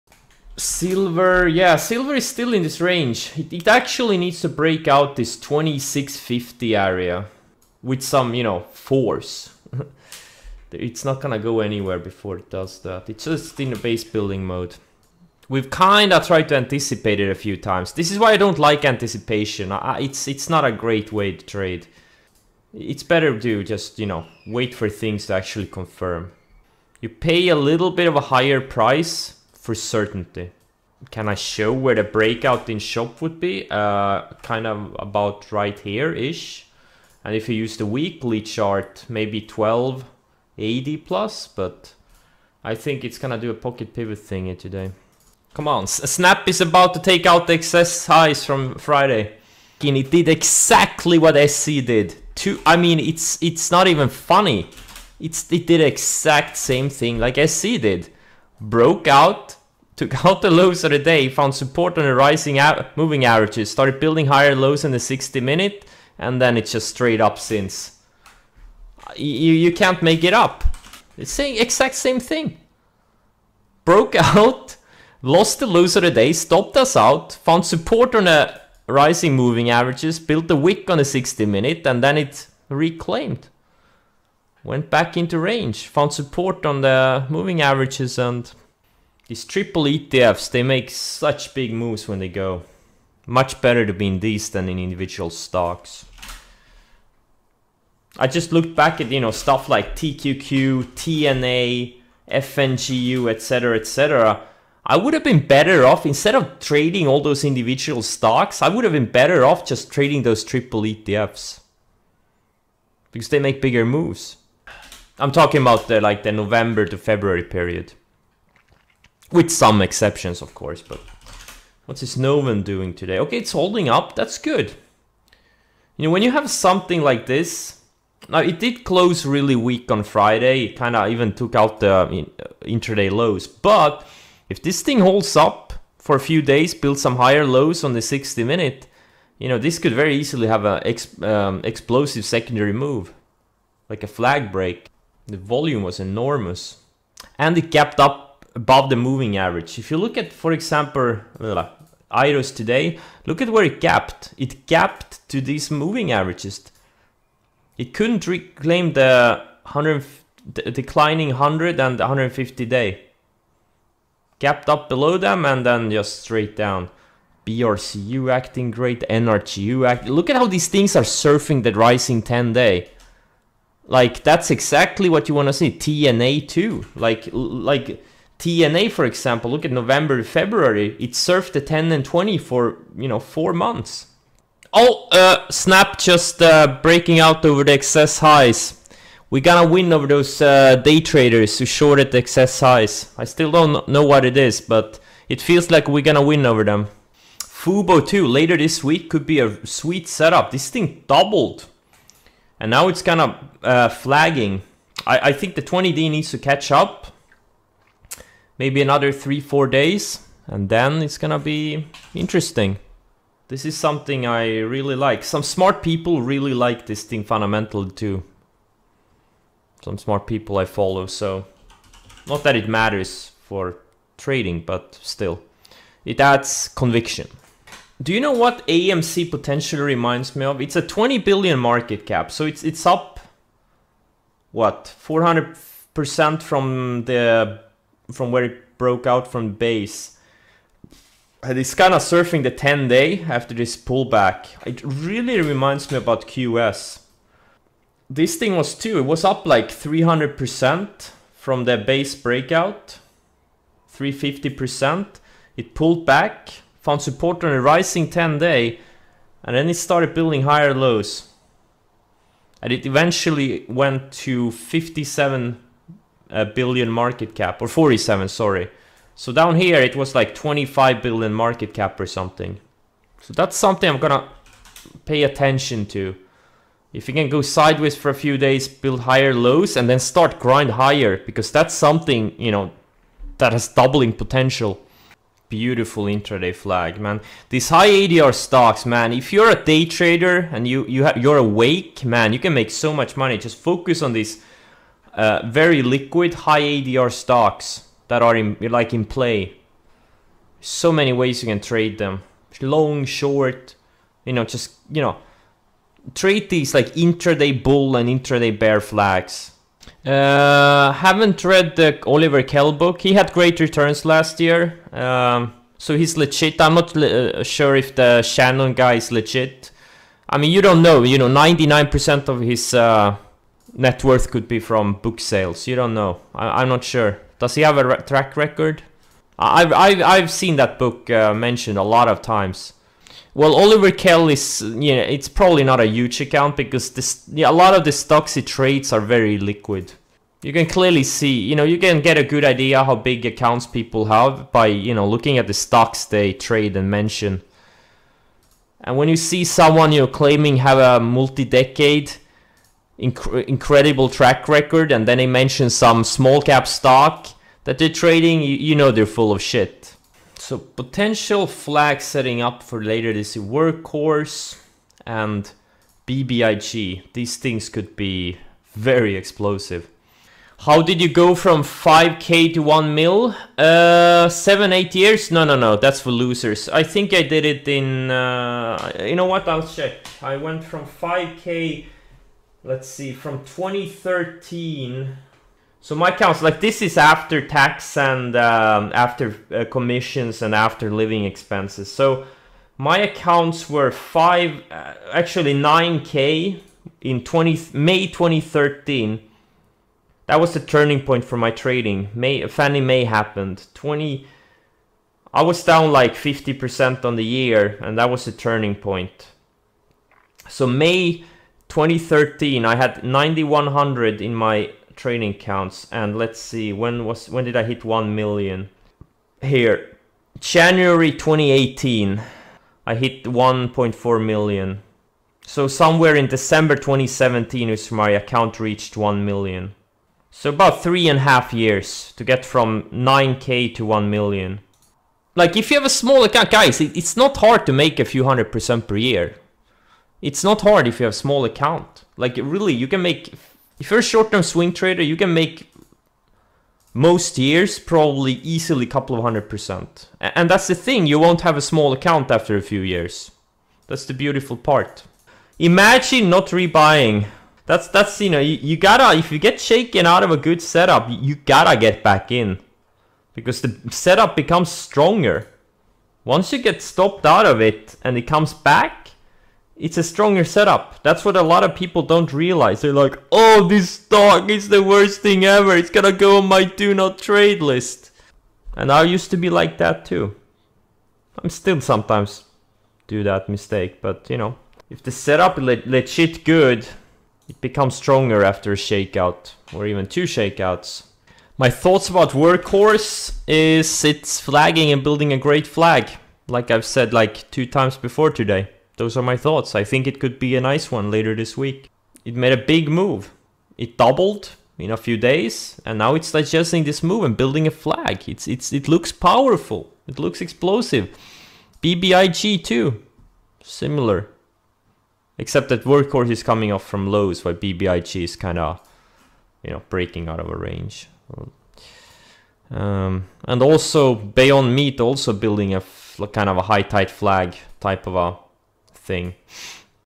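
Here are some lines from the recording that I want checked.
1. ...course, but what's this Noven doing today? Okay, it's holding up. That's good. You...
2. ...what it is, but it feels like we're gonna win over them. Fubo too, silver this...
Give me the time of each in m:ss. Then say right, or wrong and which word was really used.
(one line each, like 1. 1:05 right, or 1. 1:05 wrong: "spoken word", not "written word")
1. 2:00 right
2. 3:14 wrong: "later", not "silver".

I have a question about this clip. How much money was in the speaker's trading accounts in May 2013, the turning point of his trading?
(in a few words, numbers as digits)
9,100.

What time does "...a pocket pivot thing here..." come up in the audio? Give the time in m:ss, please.
0:43.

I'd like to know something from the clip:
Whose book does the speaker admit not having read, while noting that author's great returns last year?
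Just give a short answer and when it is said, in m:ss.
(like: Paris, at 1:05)
Oliver Kell, at 5:12.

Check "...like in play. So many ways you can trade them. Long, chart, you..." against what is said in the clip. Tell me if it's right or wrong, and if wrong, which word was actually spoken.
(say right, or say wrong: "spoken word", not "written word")
wrong: "short", not "chart".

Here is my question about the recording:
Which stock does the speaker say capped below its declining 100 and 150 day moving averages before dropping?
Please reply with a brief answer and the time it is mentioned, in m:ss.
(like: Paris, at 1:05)
IROS, at 2:32.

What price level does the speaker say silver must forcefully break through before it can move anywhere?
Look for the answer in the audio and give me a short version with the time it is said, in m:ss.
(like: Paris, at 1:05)
2650, at 0:05.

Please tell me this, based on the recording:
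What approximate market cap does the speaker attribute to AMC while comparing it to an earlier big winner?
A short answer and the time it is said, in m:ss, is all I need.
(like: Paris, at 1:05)
20 billion, at 3:50.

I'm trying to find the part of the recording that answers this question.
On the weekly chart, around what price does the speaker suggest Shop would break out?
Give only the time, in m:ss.
0:39.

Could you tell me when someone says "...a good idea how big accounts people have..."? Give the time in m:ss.
5:42.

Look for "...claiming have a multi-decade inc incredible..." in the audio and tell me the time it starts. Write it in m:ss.
5:50.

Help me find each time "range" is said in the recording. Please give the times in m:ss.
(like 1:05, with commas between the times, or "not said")
0:02, 1:25, 8:40.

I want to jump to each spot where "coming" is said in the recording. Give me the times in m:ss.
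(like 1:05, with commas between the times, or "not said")
8:36.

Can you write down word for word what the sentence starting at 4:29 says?
So down here it was like 25 billion market cap or something.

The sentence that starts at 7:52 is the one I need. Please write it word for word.
They're like, oh, this stock is the worst thing ever.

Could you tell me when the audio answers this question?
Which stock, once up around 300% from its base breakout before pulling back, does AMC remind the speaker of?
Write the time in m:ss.
4:06.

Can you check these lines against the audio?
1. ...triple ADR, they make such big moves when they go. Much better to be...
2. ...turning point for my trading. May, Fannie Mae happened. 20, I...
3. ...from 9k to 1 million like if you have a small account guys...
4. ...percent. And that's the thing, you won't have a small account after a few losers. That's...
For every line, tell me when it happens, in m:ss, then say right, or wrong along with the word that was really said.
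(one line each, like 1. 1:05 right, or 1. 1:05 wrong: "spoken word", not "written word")
1. 1:29 wrong: "ETFs", not "ADR"
2. 6:40 right
3. 7:12 right
4. 7:29 wrong: "years", not "losers".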